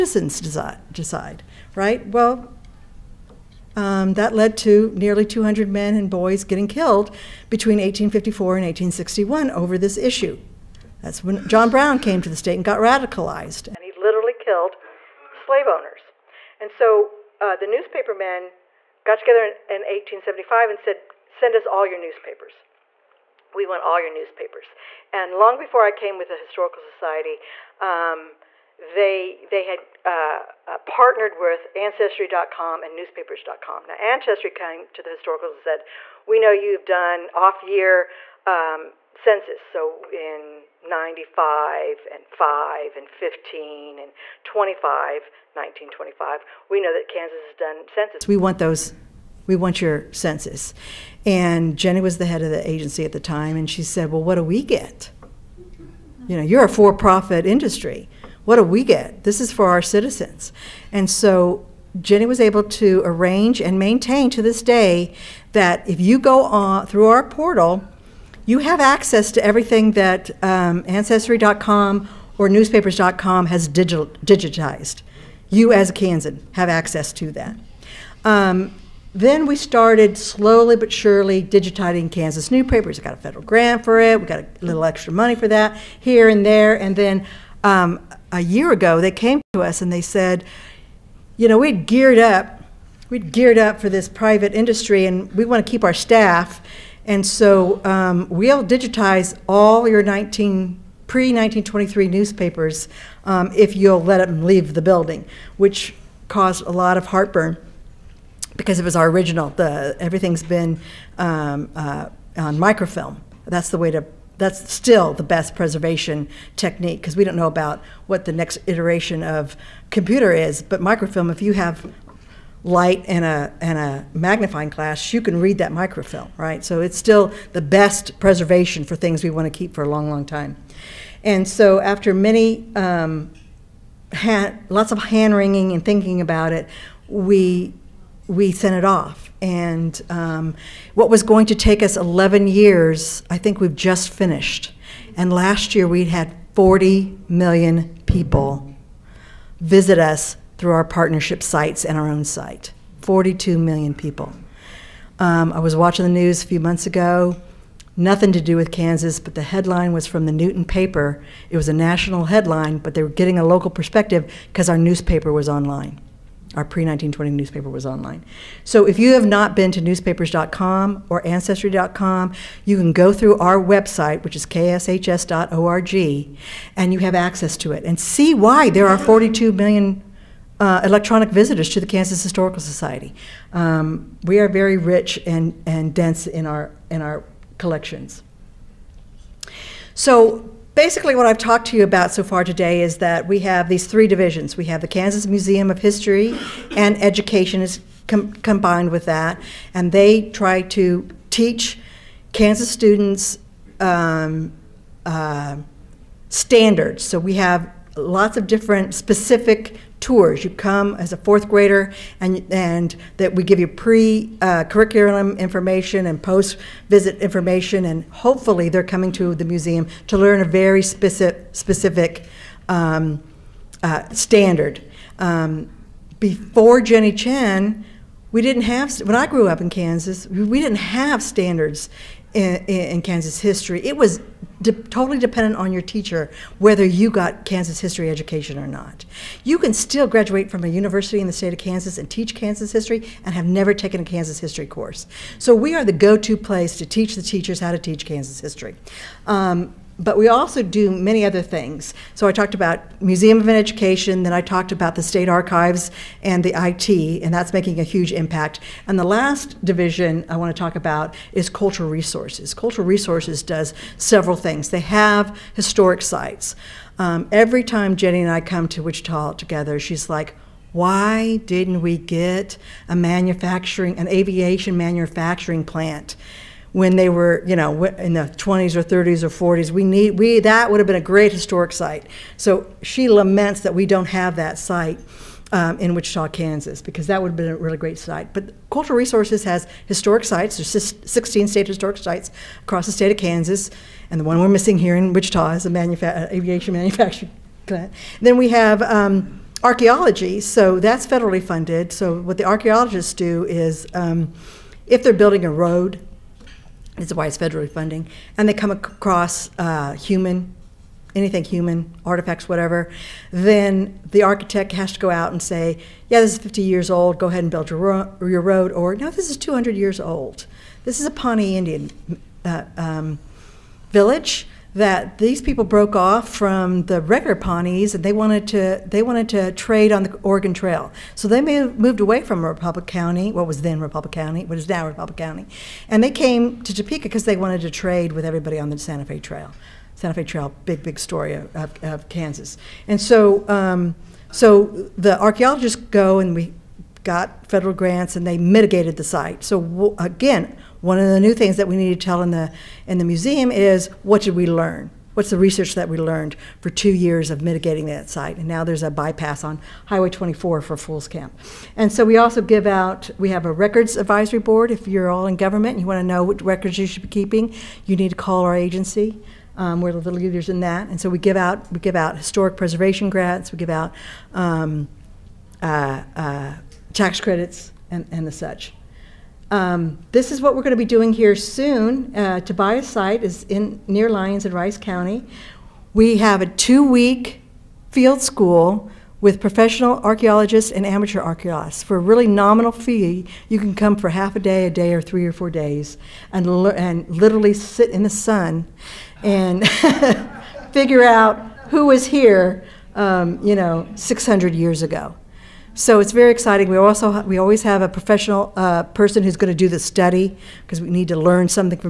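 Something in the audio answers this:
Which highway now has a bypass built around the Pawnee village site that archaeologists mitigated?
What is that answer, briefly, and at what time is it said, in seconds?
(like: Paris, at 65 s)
Highway 24, at 359 s.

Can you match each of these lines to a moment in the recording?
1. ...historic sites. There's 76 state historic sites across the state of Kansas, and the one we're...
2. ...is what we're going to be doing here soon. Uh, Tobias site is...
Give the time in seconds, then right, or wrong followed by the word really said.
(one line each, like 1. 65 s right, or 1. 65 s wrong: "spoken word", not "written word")
1. 289 s wrong: "16", not "76"
2. 380 s right.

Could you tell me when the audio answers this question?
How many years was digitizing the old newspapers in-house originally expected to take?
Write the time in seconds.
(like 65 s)
141 s.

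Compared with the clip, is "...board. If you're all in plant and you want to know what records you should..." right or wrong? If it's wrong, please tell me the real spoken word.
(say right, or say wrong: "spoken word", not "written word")
wrong: "government", not "plant".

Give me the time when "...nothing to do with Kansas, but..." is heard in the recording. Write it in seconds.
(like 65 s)
157 s.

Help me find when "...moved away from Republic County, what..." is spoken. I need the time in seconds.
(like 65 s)
331 s.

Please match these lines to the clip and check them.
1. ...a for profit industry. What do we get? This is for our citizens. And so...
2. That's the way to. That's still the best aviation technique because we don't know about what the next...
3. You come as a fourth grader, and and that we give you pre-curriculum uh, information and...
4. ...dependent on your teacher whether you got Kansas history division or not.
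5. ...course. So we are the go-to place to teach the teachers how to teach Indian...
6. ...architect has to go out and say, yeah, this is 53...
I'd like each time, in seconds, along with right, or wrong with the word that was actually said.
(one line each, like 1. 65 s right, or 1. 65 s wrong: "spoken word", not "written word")
1. 56 s right
2. 113 s wrong: "preservation", not "aviation"
3. 210 s right
4. 235 s wrong: "education", not "division"
5. 244 s wrong: "Kansas", not "Indian"
6. 314 s wrong: "50", not "53".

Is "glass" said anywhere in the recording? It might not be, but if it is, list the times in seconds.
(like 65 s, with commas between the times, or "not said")
124 s.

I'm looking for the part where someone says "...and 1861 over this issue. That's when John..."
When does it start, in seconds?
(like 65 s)
8 s.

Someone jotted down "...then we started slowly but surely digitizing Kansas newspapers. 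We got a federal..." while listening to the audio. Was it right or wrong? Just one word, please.
right.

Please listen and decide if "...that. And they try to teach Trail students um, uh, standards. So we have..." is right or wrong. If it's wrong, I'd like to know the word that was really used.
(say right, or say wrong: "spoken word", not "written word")
wrong: "Kansas", not "Trail".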